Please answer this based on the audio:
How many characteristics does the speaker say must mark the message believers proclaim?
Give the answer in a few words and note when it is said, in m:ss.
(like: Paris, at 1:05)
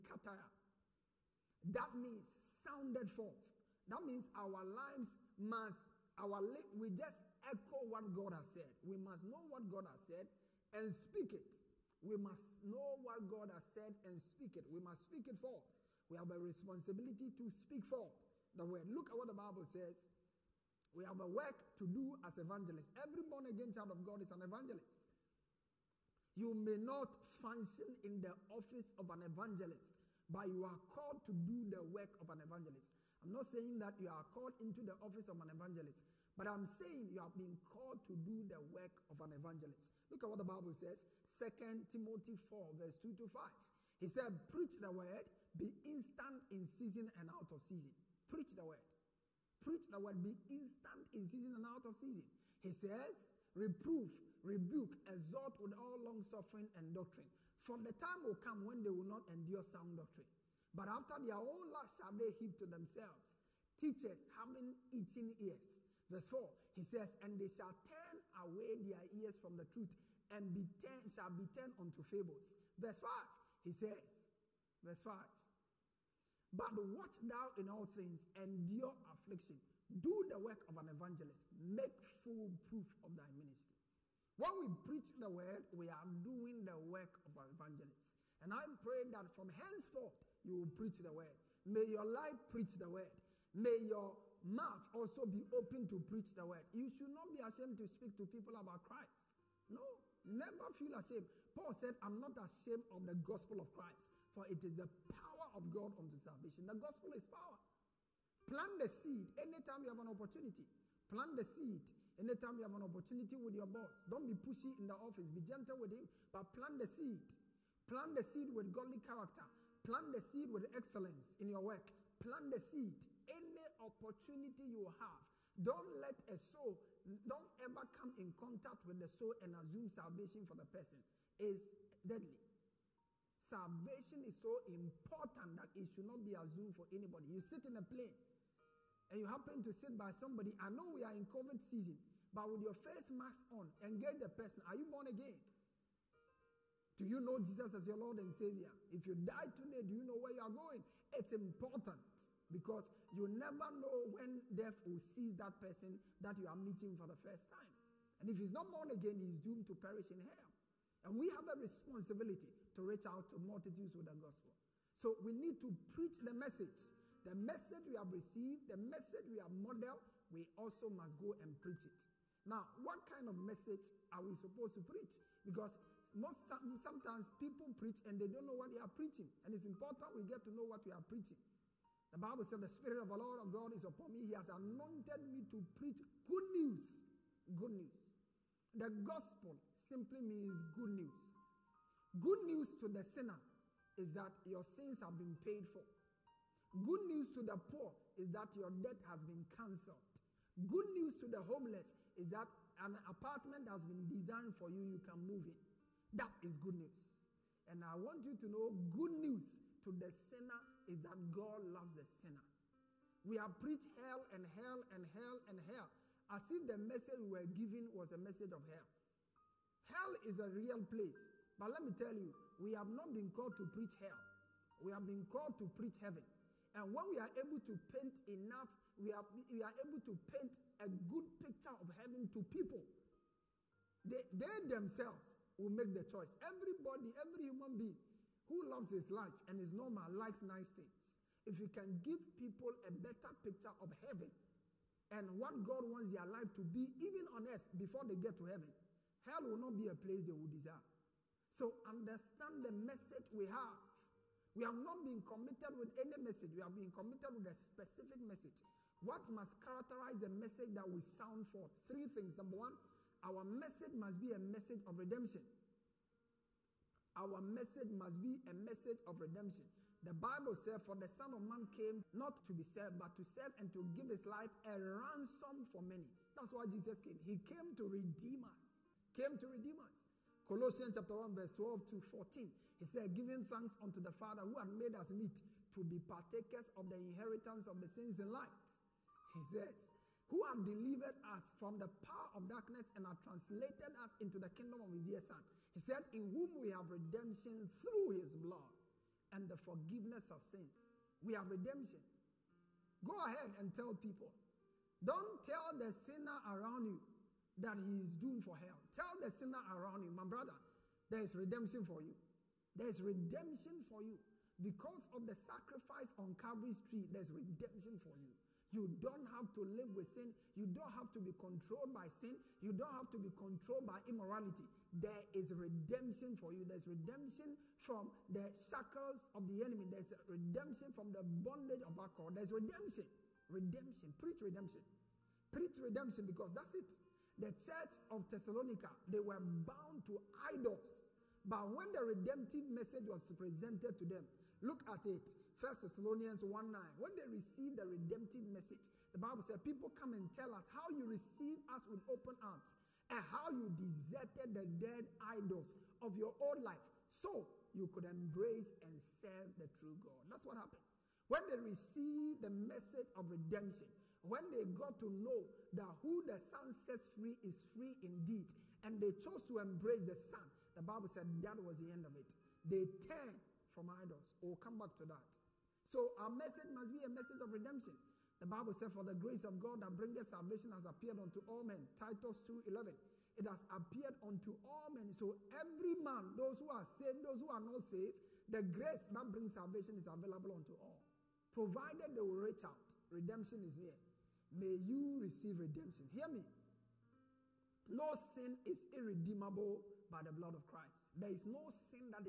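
3, at 4:21.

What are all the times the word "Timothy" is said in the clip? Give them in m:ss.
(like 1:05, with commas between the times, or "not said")
0:41.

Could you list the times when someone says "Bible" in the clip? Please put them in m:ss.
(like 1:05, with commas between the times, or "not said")
0:19, 0:40, 3:02, 4:30, 5:49, 6:10, 6:18.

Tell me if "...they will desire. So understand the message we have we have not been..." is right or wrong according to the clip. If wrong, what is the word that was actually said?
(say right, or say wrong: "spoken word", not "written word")
right.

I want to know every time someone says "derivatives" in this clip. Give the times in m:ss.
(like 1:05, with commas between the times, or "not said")
not said.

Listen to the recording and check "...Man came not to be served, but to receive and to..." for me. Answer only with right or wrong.
wrong.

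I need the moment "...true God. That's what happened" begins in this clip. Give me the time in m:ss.
5:59.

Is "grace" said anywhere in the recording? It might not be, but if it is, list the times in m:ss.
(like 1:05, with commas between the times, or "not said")
6:19, 6:28.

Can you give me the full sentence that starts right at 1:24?
When we preach the word, we are doing the work of an evangelist.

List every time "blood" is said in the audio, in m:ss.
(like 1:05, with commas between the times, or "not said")
4:58, 6:40.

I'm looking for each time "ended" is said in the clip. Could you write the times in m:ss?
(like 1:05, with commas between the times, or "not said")
not said.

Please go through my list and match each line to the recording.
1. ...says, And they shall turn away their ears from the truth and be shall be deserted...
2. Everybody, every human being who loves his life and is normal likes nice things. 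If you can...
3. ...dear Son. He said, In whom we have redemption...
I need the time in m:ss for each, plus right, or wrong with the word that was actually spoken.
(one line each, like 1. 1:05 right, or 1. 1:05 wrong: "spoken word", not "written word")
1. 1:06 wrong: "turned", not "deserted"
2. 3:56 right
3. 4:55 right.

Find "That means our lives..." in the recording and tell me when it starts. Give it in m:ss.
0:03.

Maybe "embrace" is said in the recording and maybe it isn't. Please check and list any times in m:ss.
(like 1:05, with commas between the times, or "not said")
5:58, 6:09.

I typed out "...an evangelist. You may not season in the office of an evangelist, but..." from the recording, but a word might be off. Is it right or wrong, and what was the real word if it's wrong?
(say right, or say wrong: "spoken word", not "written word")
wrong: "function", not "season".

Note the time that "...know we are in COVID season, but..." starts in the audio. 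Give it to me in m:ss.
2:20.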